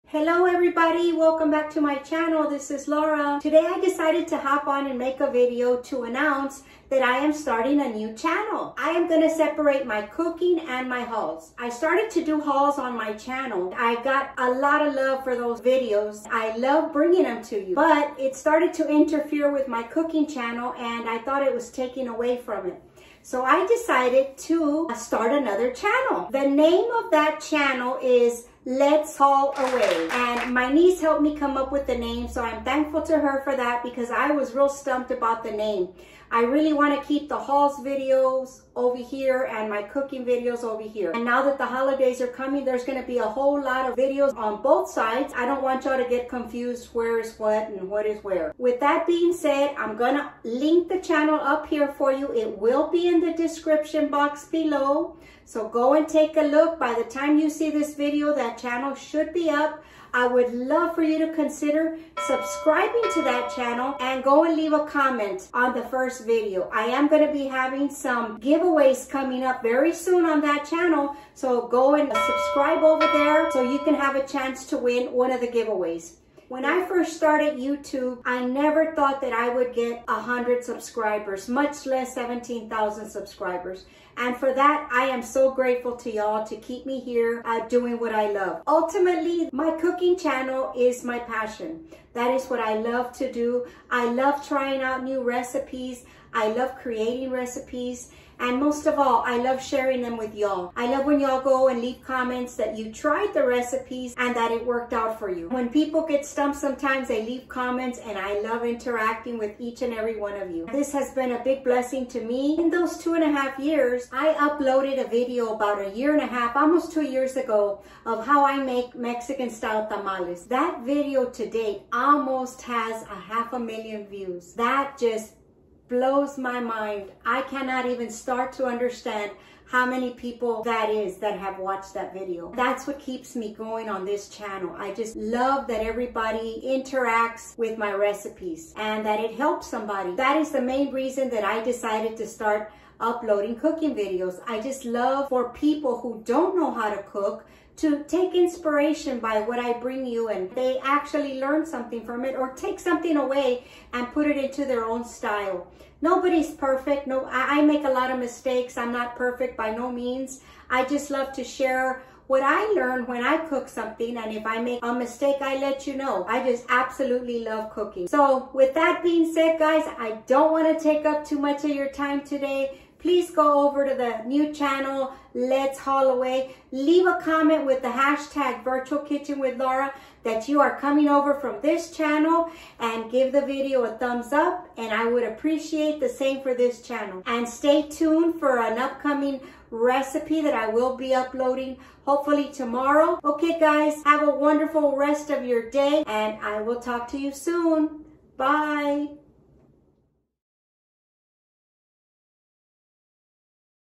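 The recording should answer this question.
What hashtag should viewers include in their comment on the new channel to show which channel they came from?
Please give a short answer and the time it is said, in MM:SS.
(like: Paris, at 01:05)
Virtual Kitchen with Laura, at 02:58.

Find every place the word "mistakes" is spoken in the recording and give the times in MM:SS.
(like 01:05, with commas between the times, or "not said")
02:38, 02:44.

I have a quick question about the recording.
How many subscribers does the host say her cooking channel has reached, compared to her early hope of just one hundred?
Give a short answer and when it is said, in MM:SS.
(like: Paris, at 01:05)
17,000, at 01:22.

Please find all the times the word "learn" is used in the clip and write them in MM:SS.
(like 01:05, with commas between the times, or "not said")
02:31, 02:42.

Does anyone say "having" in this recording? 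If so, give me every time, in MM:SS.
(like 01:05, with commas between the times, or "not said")
01:07.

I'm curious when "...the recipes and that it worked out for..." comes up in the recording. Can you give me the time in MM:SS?
01:43.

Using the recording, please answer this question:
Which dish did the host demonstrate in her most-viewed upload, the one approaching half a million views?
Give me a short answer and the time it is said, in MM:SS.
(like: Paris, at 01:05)
Mexican style tamales, at 01:58.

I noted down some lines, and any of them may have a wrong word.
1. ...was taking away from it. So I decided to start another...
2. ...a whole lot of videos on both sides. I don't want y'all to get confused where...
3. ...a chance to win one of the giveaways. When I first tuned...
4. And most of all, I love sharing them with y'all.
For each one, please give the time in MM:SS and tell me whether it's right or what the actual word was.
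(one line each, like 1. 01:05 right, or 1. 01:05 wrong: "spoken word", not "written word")
1. 00:21 right
2. 00:43 right
3. 01:14 wrong: "started", not "tuned"
4. 01:38 right.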